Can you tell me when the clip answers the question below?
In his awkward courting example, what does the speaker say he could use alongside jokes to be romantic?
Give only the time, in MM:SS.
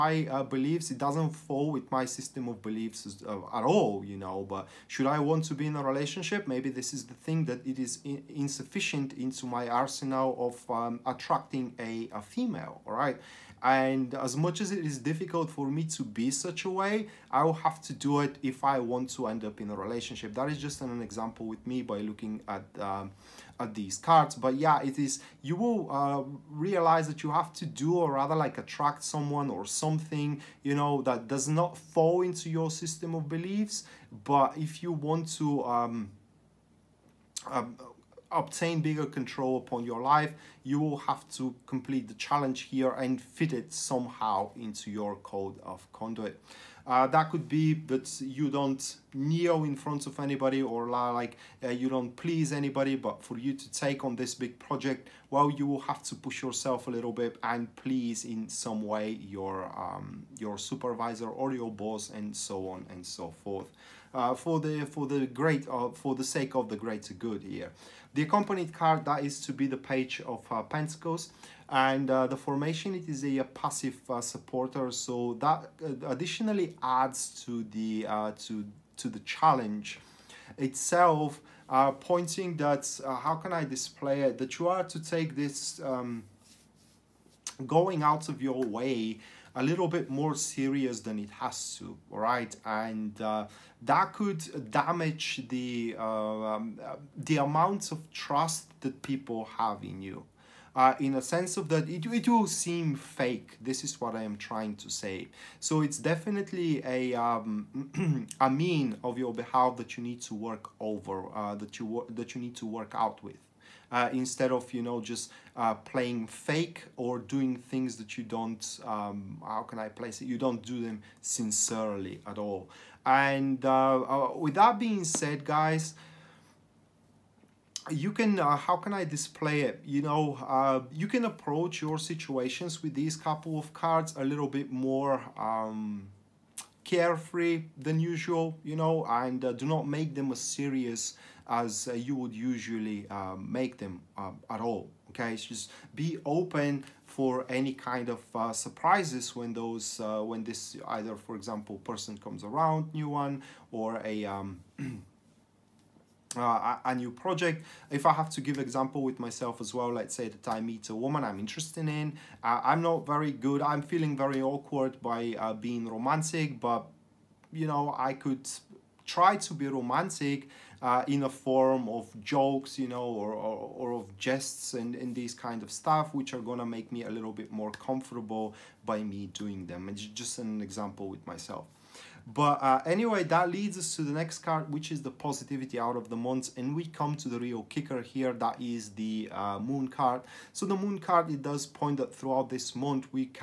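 02:54.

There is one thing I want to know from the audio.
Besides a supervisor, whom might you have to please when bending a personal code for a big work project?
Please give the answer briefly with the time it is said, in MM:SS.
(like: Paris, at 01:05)
Your boss, at 01:01.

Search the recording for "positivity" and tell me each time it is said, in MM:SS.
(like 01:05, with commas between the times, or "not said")
03:05.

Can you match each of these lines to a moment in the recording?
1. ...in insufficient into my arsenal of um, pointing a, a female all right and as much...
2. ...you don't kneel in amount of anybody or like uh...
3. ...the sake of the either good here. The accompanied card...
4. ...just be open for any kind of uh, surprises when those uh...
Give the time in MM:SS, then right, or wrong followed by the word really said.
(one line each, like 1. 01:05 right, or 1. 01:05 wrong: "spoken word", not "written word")
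1. 00:08 wrong: "attracting", not "pointing"
2. 00:48 wrong: "front", not "amount"
3. 01:06 wrong: "greater", not "either"
4. 02:25 right.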